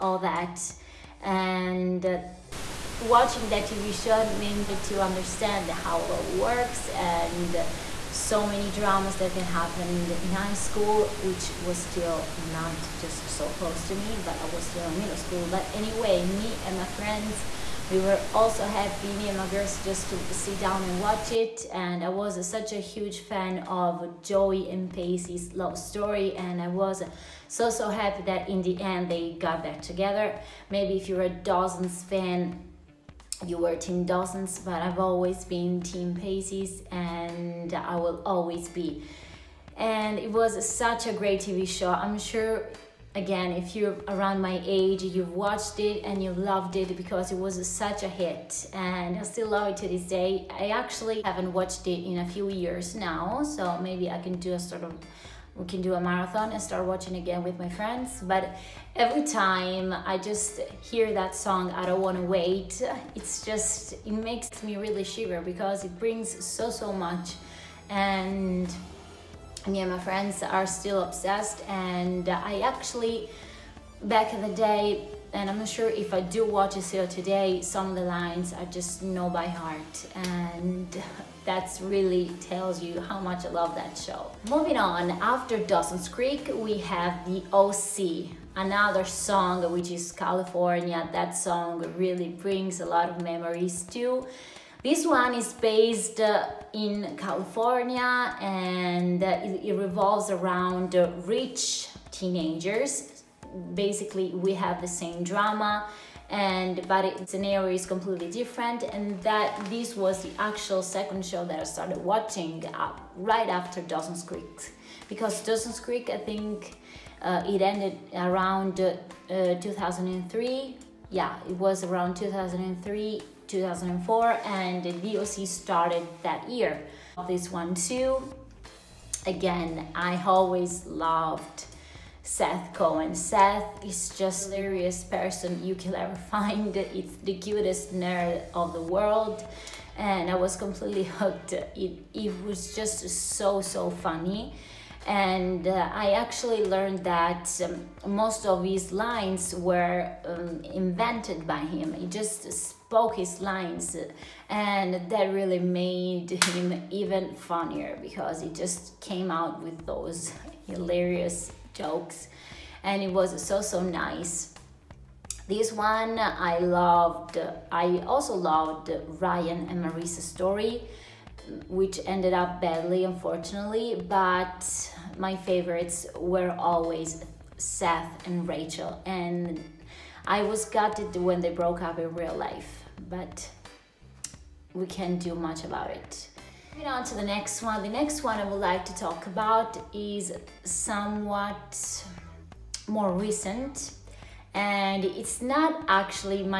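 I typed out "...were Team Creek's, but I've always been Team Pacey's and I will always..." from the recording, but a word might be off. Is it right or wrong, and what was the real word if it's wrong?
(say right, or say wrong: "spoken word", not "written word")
wrong: "Dawson", not "Creek".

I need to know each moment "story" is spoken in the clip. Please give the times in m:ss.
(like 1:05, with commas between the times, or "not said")
0:25, 2:50.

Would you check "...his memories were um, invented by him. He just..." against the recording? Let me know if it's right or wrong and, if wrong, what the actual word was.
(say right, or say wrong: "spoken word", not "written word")
wrong: "lines", not "memories".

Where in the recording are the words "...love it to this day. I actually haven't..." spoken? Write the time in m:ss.
0:49.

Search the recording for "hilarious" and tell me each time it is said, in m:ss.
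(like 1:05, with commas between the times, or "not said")
2:14, 2:40.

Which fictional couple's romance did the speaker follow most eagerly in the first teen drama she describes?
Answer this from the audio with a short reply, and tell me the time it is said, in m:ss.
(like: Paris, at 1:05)
Joey and Pacey, at 0:24.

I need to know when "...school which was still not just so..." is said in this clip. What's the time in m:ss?
0:10.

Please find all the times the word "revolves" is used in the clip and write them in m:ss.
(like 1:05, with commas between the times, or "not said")
1:39.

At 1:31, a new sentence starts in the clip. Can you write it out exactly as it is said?
That song really brings a lot of memories too.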